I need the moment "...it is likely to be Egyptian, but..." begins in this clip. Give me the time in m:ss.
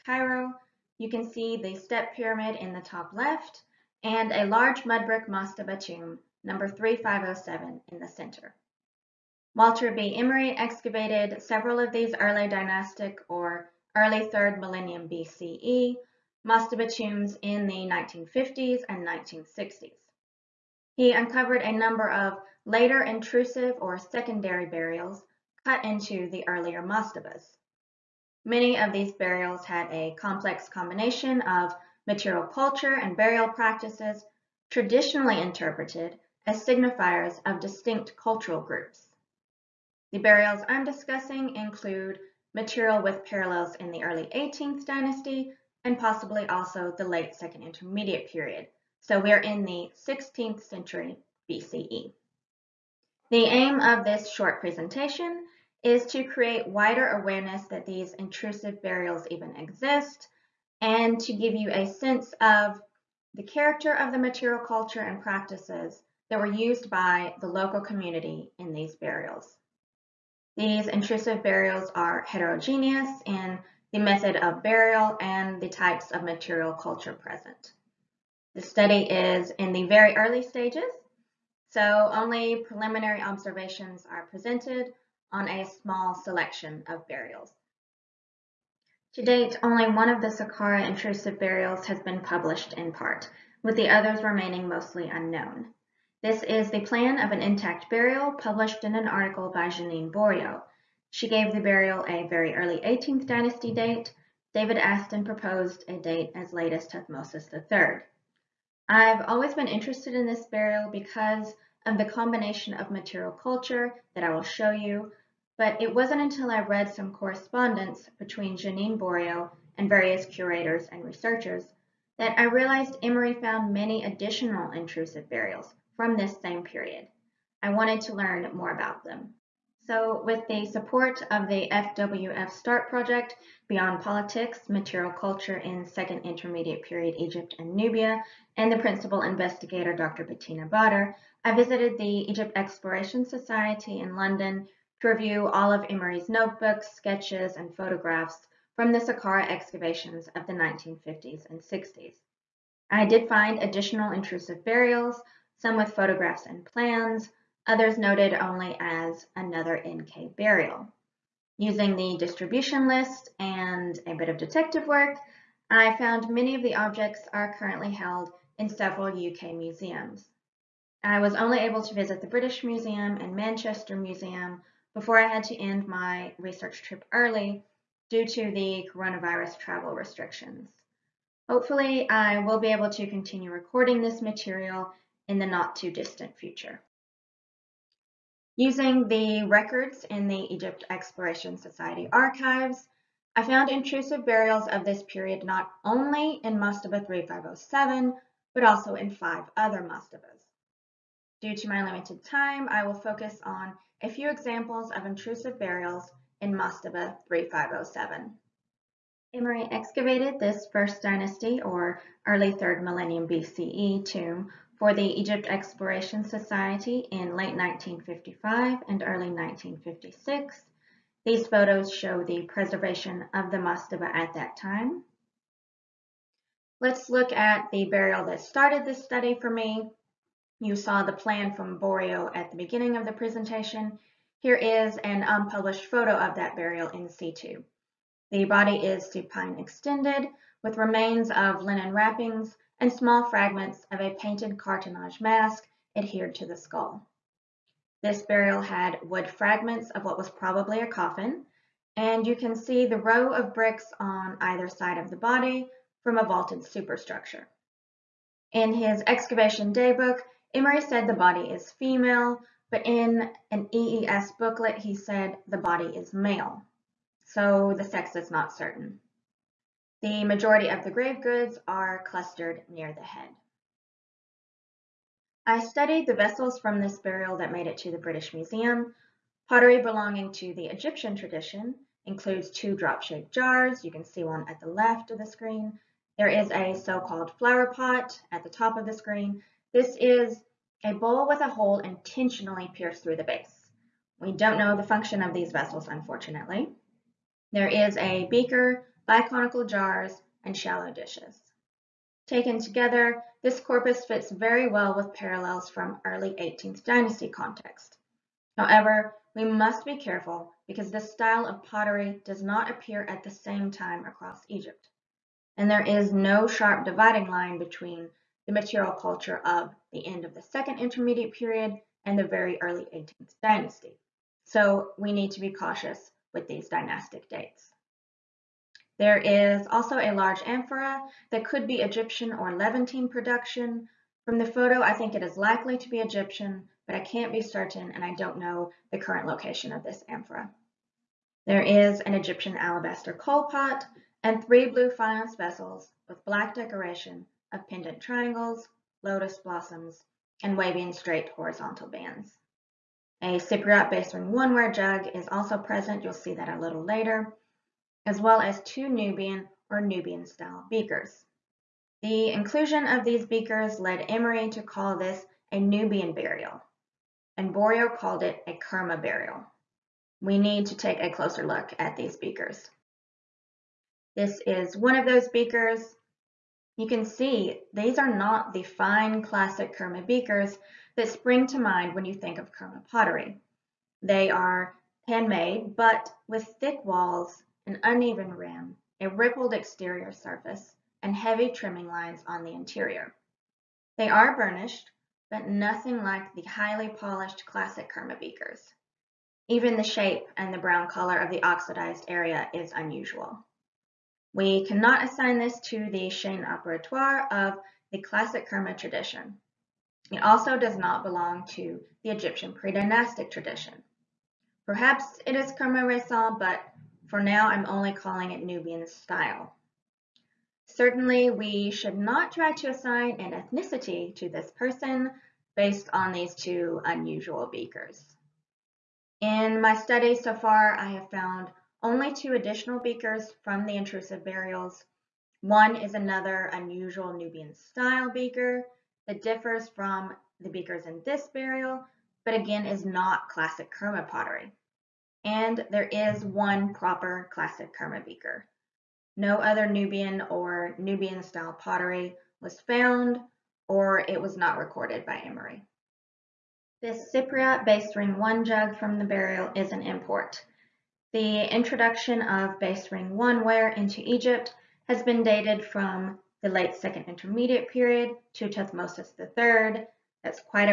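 5:35.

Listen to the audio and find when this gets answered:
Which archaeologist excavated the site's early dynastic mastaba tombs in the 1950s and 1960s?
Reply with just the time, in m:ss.
0:09.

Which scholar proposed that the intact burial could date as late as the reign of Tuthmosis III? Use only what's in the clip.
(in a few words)
David Aston.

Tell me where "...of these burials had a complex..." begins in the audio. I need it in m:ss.
0:28.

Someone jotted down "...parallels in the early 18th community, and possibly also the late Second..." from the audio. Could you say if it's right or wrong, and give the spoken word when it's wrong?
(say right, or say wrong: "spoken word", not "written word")
wrong: "dynasty", not "community".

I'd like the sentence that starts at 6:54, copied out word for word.
Perhaps it is Kerma Resal, but for now, I'm only calling it Nubian style.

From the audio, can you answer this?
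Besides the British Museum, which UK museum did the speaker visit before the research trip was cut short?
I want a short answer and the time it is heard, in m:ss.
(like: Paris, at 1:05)
Manchester Museum, at 2:53.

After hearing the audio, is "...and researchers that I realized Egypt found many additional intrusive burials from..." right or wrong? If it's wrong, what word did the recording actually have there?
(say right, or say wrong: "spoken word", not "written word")
wrong: "Emery", not "Egypt".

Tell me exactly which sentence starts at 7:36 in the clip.
This Cypriot base ring one jug from the burial is an import.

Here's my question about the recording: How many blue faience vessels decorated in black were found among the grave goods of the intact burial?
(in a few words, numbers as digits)
3.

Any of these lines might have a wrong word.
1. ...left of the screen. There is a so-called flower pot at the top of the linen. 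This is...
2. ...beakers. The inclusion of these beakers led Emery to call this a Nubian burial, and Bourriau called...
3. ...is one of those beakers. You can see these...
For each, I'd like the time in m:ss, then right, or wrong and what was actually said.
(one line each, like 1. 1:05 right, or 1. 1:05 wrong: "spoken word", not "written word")
1. 4:44 wrong: "screen", not "linen"
2. 6:00 right
3. 6:14 right.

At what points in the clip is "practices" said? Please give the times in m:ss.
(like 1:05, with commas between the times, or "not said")
0:33, 1:05.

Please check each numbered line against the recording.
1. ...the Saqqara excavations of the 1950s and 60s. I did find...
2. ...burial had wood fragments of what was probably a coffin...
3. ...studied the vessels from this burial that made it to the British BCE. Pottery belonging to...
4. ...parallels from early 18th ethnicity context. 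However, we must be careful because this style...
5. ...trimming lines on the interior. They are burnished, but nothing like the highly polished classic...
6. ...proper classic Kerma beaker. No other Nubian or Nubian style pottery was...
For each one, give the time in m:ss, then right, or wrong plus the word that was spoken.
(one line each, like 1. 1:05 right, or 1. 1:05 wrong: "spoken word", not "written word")
1. 2:28 right
2. 4:08 right
3. 4:35 wrong: "Museum", not "BCE"
4. 5:05 wrong: "dynasty", not "ethnicity"
5. 6:31 right
6. 7:26 right.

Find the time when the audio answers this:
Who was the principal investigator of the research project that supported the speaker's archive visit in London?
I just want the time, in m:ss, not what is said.
2:19.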